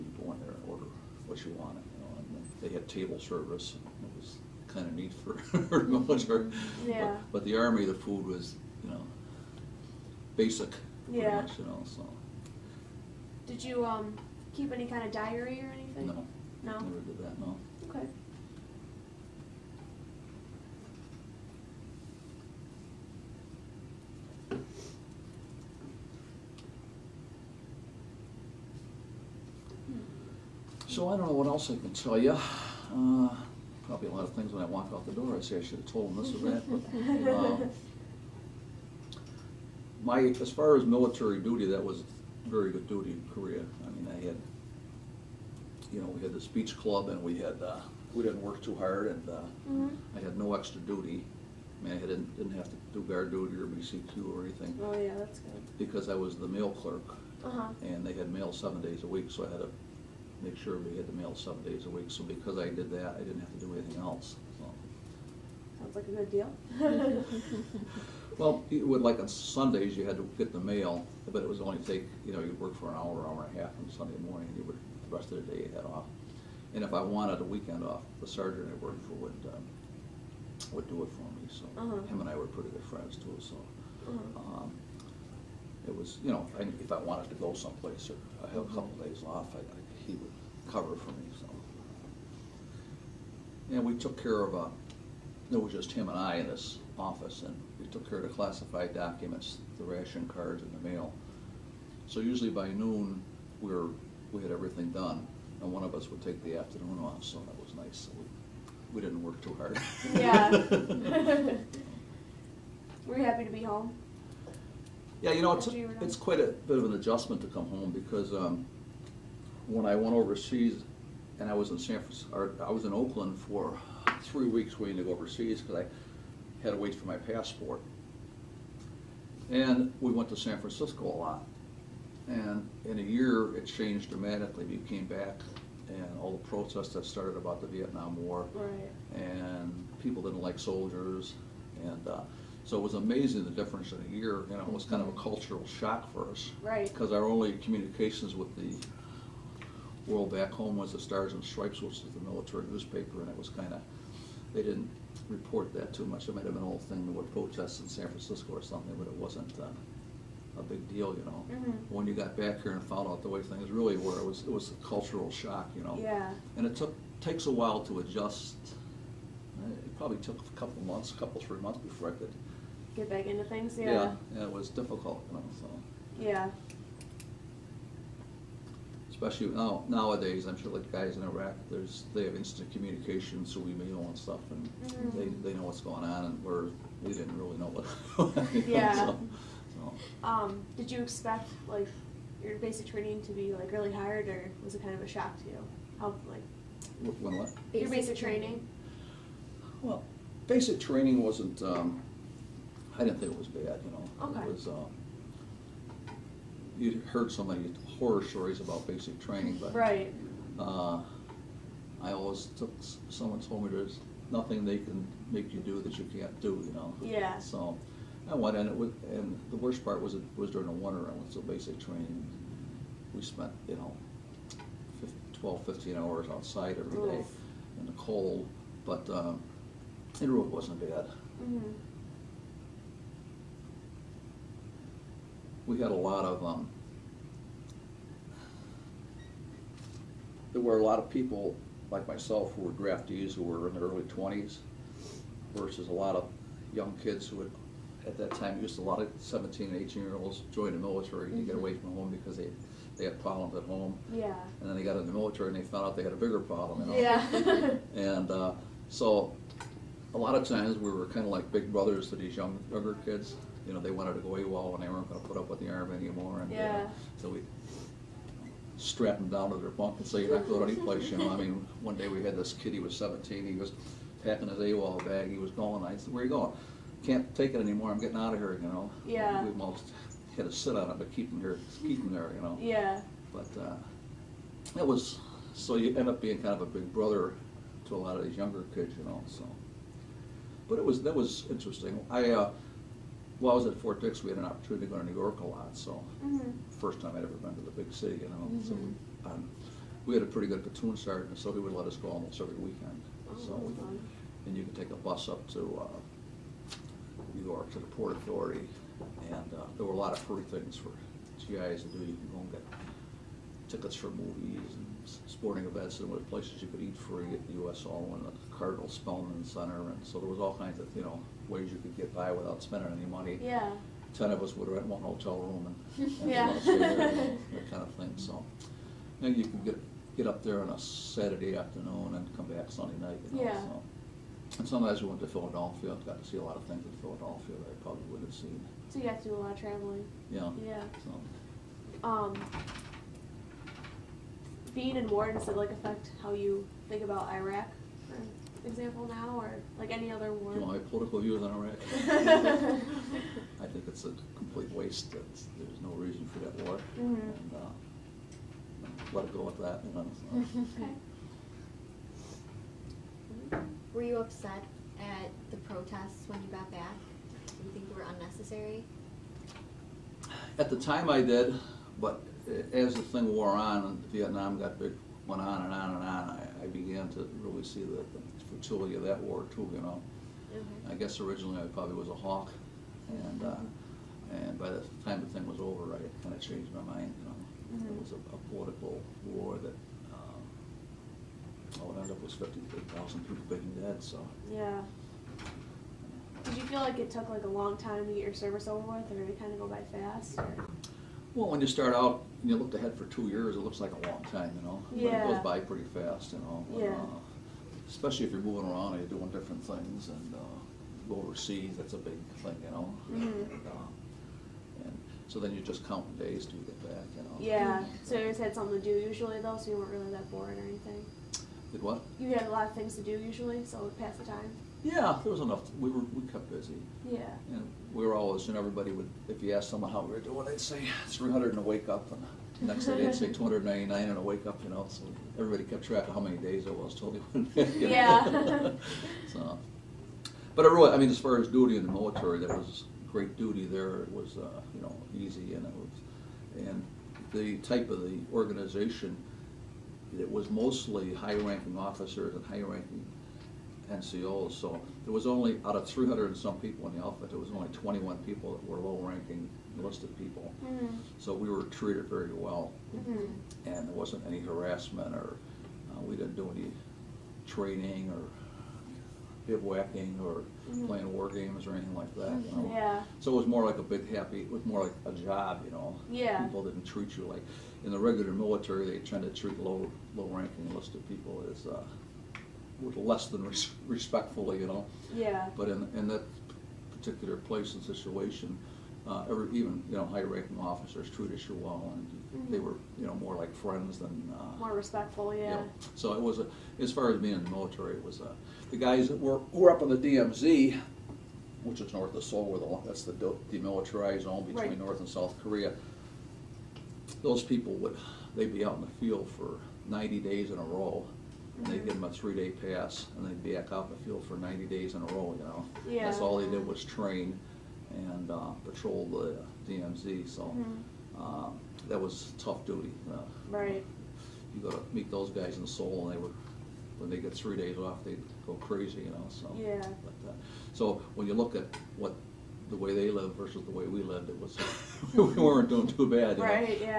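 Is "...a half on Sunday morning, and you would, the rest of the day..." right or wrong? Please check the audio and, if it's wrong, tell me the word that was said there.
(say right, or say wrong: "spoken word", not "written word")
right.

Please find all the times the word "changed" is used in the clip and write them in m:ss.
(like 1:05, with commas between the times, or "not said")
2:13, 6:26.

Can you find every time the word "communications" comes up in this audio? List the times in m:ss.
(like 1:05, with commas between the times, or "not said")
2:27, 3:02.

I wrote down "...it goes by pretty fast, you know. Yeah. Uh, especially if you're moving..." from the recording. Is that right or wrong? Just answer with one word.
right.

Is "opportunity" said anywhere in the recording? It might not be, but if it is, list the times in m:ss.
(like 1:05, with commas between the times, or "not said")
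4:54.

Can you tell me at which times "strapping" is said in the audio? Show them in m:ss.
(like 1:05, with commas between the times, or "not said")
4:28.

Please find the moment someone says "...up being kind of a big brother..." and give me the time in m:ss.
4:46.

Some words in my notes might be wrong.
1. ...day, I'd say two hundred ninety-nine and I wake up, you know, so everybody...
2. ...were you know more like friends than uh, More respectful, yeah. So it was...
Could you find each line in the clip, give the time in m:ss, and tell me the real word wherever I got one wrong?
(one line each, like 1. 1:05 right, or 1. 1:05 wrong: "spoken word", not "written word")
1. 7:12 right
2. 8:12 right.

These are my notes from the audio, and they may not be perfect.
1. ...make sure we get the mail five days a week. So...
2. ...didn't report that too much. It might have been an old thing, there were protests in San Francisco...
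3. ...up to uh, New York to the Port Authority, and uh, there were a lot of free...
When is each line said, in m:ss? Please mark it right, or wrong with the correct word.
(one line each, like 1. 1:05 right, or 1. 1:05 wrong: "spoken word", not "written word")
1. 1:00 wrong: "seven", not "five"
2. 2:34 right
3. 5:05 right.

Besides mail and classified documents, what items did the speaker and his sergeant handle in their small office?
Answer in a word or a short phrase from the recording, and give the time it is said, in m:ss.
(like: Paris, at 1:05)
ration cards, at 1:39.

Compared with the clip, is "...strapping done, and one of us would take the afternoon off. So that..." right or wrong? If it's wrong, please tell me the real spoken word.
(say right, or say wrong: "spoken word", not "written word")
wrong: "everything", not "strapping".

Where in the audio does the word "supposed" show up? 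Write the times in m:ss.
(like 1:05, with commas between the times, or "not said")
not said.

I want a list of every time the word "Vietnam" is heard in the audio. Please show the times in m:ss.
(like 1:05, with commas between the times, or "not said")
2:17, 6:14.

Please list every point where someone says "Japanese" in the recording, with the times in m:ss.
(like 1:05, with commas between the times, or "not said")
not said.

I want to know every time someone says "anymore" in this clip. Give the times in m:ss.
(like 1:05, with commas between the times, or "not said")
4:25, 4:37.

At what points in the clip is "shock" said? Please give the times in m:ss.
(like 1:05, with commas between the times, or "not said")
2:25, 2:45, 3:15.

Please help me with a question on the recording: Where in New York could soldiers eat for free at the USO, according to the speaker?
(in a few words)
Cardinal Spellman Center.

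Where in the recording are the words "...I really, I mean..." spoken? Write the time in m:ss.
7:20.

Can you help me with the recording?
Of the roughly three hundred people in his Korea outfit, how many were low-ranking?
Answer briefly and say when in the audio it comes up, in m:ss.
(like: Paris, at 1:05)
21, at 7:37.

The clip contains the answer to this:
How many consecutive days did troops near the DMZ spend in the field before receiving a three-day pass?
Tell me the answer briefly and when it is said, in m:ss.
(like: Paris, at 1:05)
90, at 8:29.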